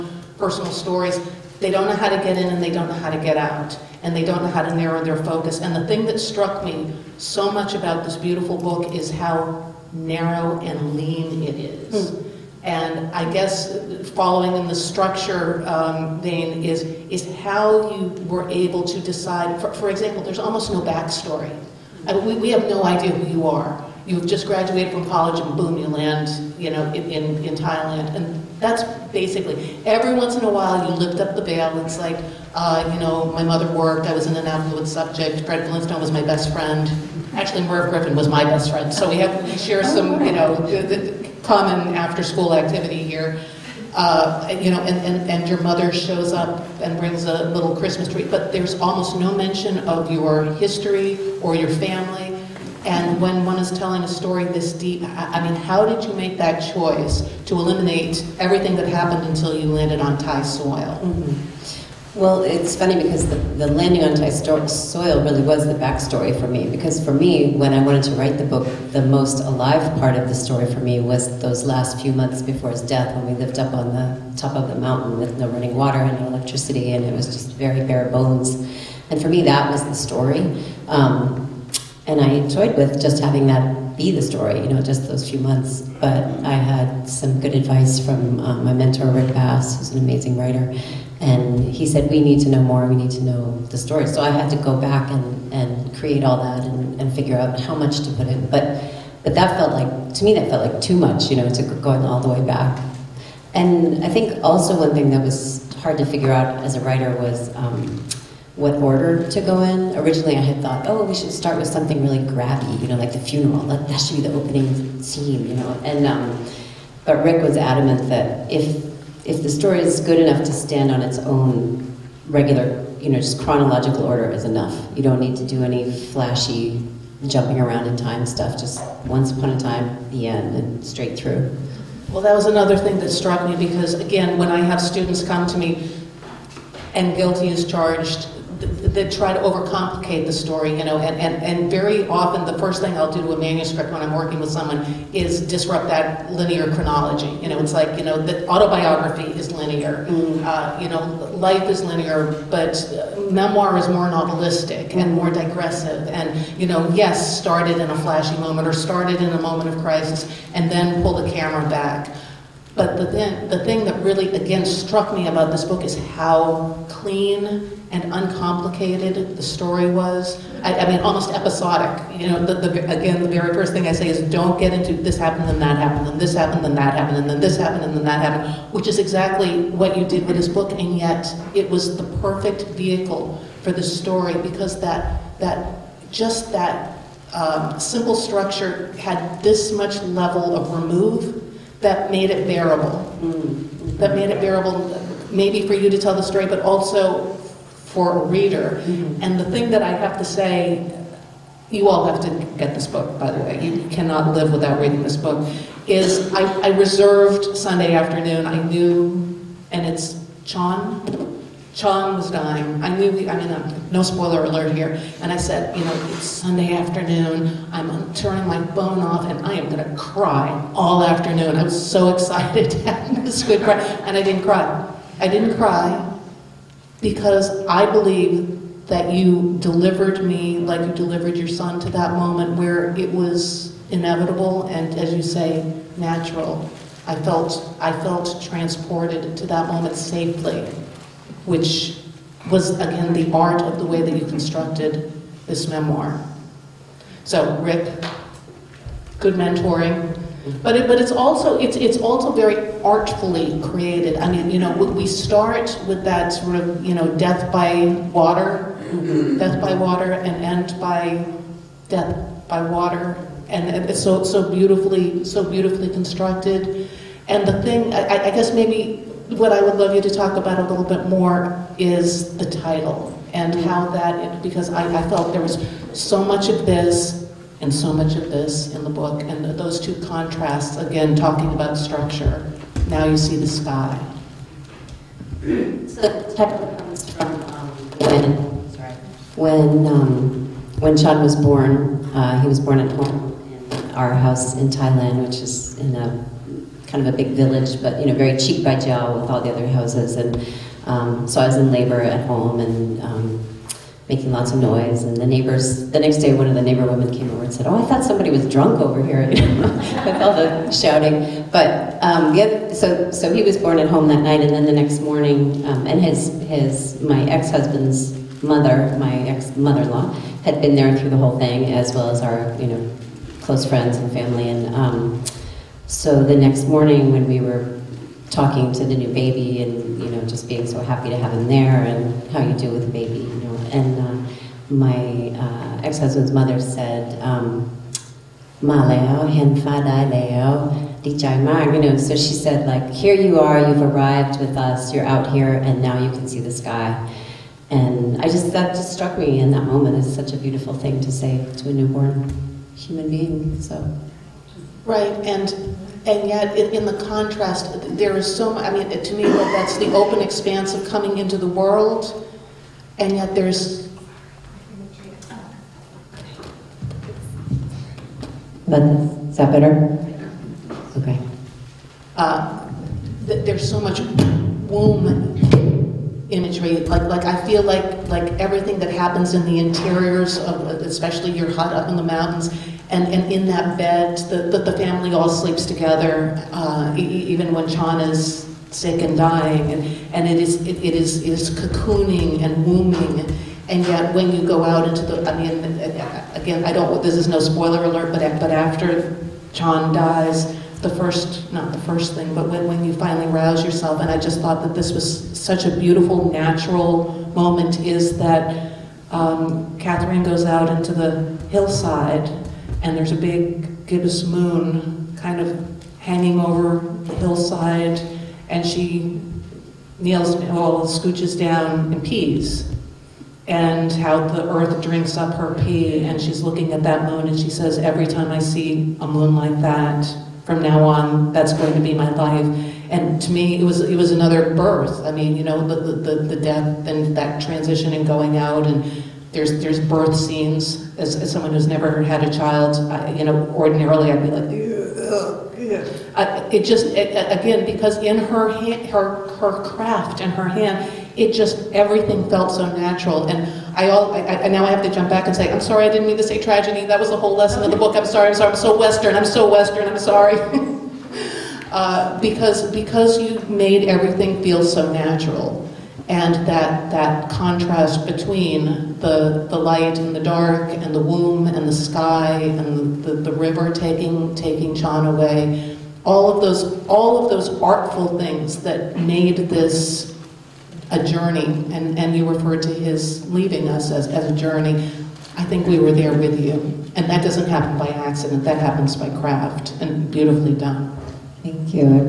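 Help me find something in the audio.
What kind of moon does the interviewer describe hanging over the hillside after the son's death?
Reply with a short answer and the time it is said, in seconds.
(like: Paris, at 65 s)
gibbous, at 413 s.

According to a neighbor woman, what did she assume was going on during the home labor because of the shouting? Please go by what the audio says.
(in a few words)
somebody was drunk.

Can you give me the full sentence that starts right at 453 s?
And I all I, I, now I have to jump back and say, I'm sorry, I didn't mean to say tragedy.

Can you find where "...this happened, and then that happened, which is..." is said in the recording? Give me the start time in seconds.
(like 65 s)
177 s.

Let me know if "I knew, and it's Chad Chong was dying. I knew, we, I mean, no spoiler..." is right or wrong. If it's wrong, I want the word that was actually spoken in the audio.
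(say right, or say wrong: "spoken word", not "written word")
wrong: "John", not "Chad".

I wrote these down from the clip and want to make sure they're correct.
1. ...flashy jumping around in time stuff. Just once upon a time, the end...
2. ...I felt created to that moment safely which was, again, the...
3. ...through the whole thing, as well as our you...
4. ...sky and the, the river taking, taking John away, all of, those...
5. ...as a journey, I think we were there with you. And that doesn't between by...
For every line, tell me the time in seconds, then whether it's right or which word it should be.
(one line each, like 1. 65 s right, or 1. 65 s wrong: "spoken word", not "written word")
1. 125 s right
2. 237 s wrong: "transported", not "created"
3. 320 s right
4. 471 s right
5. 484 s wrong: "happen", not "between".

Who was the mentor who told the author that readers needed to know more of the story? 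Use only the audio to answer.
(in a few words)
Rick Bass.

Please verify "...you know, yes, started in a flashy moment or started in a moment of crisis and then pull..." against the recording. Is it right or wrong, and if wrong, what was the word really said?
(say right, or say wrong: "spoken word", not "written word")
right.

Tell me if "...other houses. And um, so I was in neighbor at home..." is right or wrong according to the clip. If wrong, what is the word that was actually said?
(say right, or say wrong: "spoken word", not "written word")
wrong: "labor", not "neighbor".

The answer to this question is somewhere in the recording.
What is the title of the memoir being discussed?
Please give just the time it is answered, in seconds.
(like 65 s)
282 s.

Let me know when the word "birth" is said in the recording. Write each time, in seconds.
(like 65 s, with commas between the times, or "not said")
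434 s, 439 s.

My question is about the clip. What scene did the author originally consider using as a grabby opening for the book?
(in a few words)
the funeral.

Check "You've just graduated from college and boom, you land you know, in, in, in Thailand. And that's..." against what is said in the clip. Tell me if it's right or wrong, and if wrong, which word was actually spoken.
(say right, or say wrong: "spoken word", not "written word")
right.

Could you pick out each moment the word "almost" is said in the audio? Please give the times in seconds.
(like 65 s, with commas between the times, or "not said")
20 s, 48 s, 170 s.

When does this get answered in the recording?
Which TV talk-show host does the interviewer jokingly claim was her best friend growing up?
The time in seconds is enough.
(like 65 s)
37 s.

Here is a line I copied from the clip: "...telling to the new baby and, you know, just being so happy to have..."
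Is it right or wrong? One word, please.
wrong.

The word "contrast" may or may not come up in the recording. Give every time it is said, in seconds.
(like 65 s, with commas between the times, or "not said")
280 s, 357 s, 467 s.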